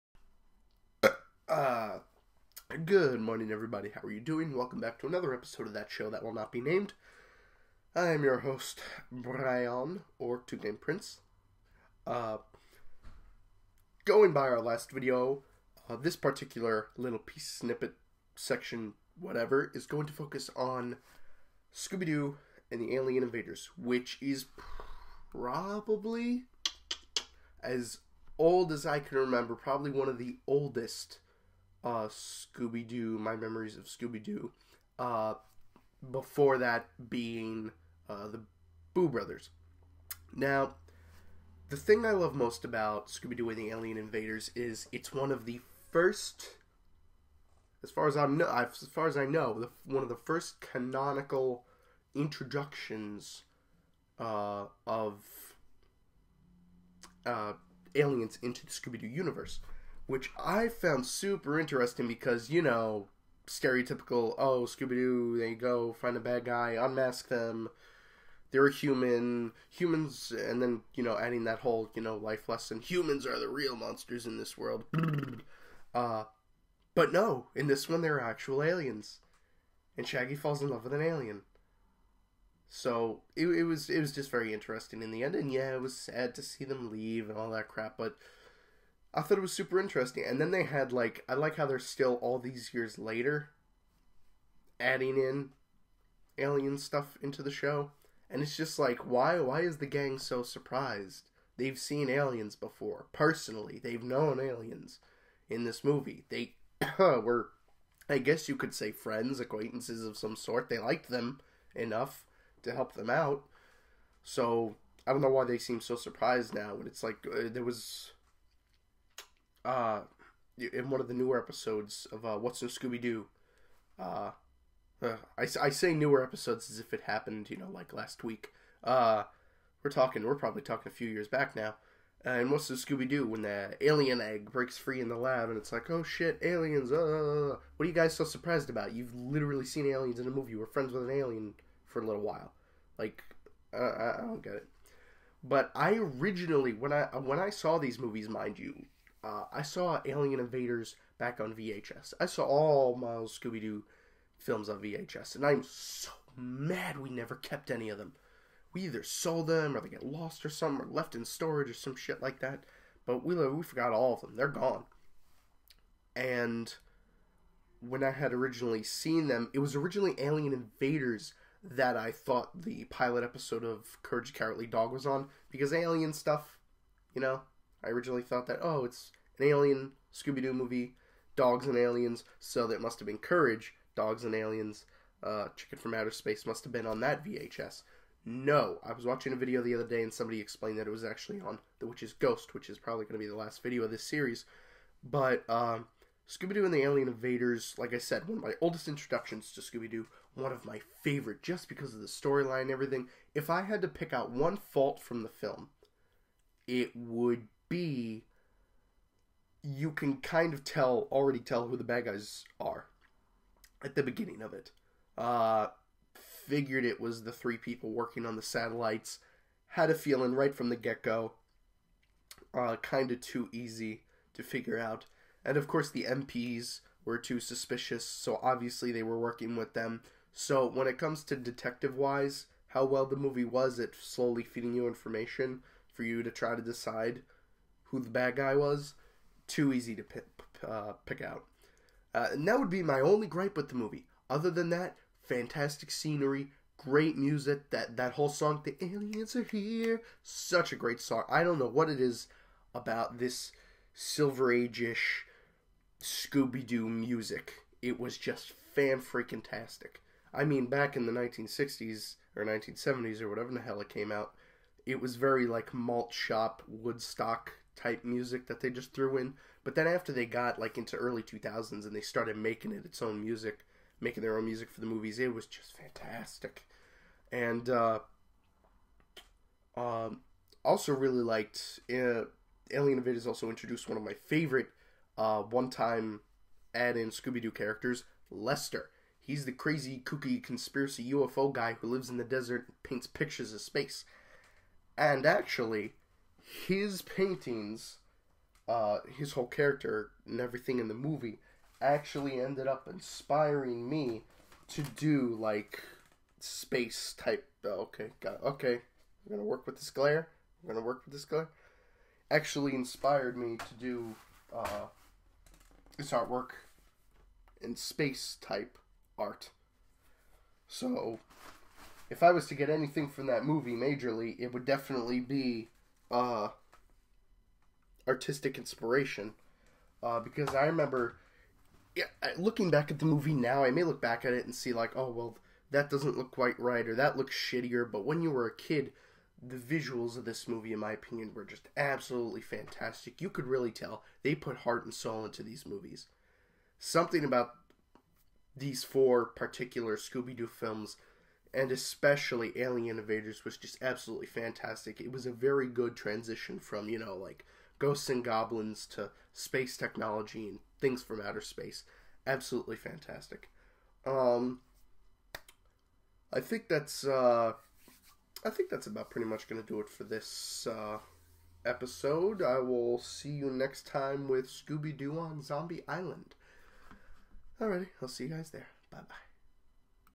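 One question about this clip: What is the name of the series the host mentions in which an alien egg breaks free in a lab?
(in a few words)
What's New Scooby Doo.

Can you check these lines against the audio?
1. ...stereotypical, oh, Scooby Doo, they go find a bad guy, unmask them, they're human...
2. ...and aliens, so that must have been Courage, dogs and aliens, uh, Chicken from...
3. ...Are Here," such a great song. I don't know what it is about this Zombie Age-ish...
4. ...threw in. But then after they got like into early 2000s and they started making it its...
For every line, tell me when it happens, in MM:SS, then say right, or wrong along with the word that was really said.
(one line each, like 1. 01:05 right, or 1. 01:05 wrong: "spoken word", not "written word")
1. 01:03 right
2. 03:01 right
3. 04:09 wrong: "Silver", not "Zombie"
4. 04:28 right.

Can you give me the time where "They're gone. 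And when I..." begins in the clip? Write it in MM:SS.
02:44.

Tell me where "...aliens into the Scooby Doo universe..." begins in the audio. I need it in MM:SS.
00:57.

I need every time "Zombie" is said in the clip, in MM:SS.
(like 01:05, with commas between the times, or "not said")
06:15.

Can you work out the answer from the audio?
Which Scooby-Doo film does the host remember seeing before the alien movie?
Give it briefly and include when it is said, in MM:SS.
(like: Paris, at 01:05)
The Boo Brothers, at 00:38.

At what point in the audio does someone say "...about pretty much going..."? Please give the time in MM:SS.
06:08.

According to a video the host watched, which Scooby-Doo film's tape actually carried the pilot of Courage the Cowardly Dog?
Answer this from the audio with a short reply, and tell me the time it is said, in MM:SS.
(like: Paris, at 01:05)
The Witch's Ghost, at 03:11.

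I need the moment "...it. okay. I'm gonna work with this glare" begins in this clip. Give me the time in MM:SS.
05:08.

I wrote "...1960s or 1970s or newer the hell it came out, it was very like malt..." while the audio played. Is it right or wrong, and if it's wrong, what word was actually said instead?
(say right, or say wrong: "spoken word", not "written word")
wrong: "whatever", not "newer".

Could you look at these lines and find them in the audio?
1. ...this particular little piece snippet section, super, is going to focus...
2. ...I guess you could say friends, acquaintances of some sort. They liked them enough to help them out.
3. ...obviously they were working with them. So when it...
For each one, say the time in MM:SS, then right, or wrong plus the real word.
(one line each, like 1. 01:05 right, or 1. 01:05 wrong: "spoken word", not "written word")
1. 00:15 wrong: "whatever", not "super"
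2. 01:48 right
3. 03:48 right.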